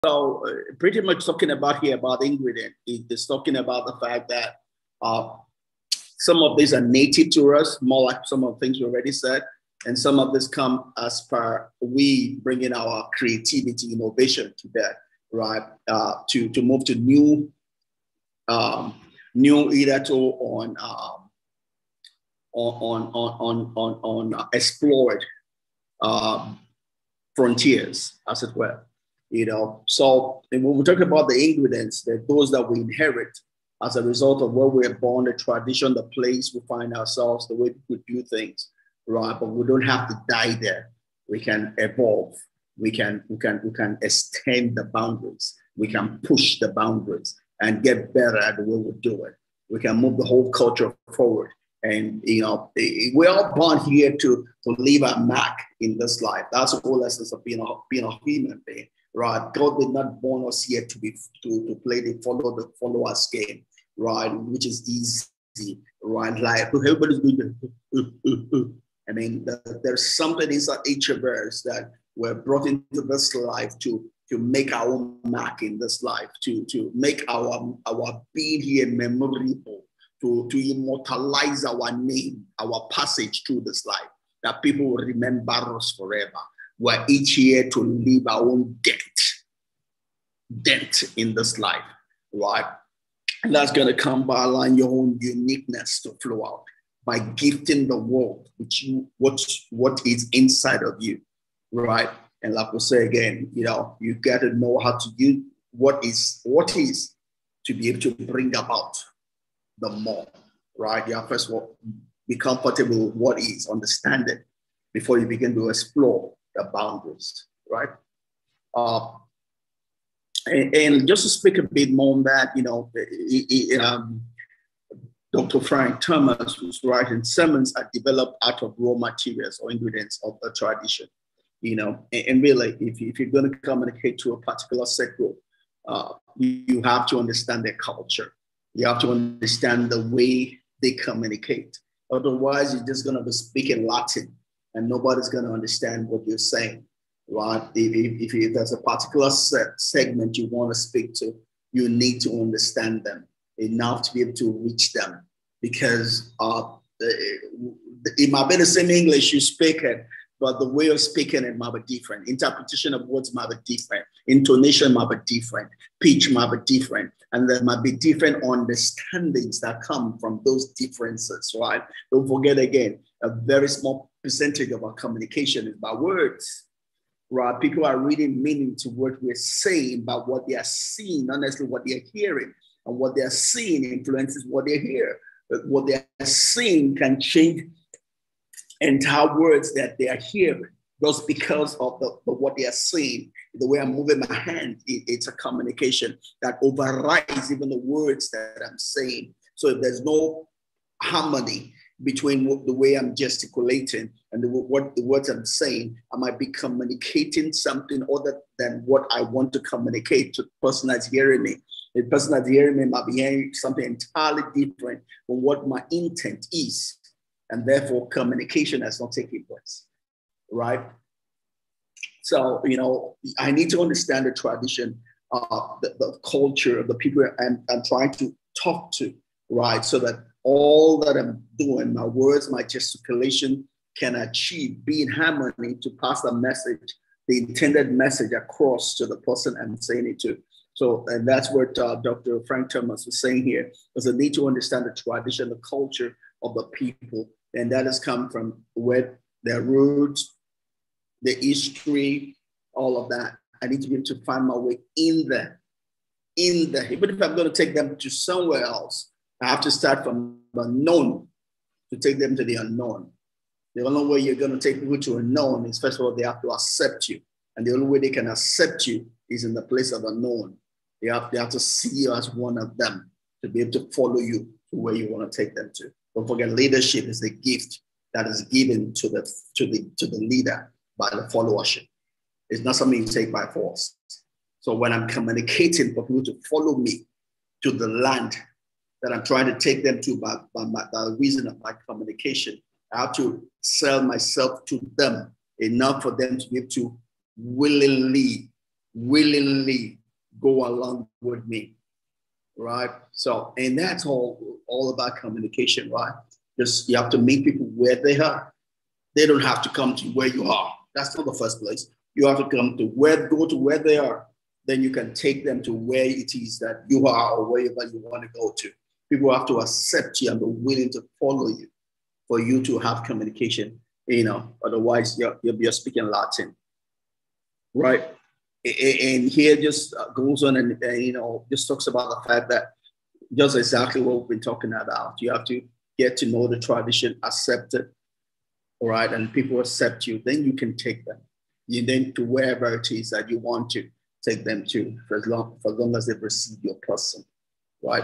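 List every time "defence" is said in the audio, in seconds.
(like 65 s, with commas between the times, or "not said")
not said.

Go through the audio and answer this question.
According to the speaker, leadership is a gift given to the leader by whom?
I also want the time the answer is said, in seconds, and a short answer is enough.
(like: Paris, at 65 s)
the followership, at 281 s.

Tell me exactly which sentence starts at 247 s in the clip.
And that has come from where their roots, the history, all of that.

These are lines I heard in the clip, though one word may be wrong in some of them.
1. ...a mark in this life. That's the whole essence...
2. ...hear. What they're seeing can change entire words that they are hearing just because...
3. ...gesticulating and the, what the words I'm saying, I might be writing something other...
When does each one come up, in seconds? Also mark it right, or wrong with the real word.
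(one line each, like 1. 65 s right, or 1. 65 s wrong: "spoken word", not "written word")
1. 55 s right
2. 184 s right
3. 203 s wrong: "communicating", not "writing".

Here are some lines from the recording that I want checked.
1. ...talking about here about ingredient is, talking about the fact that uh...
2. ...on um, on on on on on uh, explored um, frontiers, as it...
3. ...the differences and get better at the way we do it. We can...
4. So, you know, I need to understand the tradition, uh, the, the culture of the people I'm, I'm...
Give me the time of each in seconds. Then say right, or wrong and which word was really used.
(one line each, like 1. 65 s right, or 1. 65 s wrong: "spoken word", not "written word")
1. 1 s right
2. 20 s right
3. 46 s wrong: "boundaries", not "differences"
4. 222 s right.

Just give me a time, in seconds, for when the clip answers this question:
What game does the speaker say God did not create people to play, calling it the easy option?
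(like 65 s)
62 s.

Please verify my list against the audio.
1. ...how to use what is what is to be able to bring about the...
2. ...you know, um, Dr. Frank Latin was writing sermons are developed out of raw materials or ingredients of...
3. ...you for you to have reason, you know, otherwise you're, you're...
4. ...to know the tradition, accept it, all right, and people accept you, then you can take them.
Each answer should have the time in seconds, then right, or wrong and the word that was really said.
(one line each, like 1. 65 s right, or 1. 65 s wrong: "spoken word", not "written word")
1. 104 s right
2. 122 s wrong: "Thomas", not "Latin"
3. 321 s wrong: "communication", not "reason"
4. 336 s right.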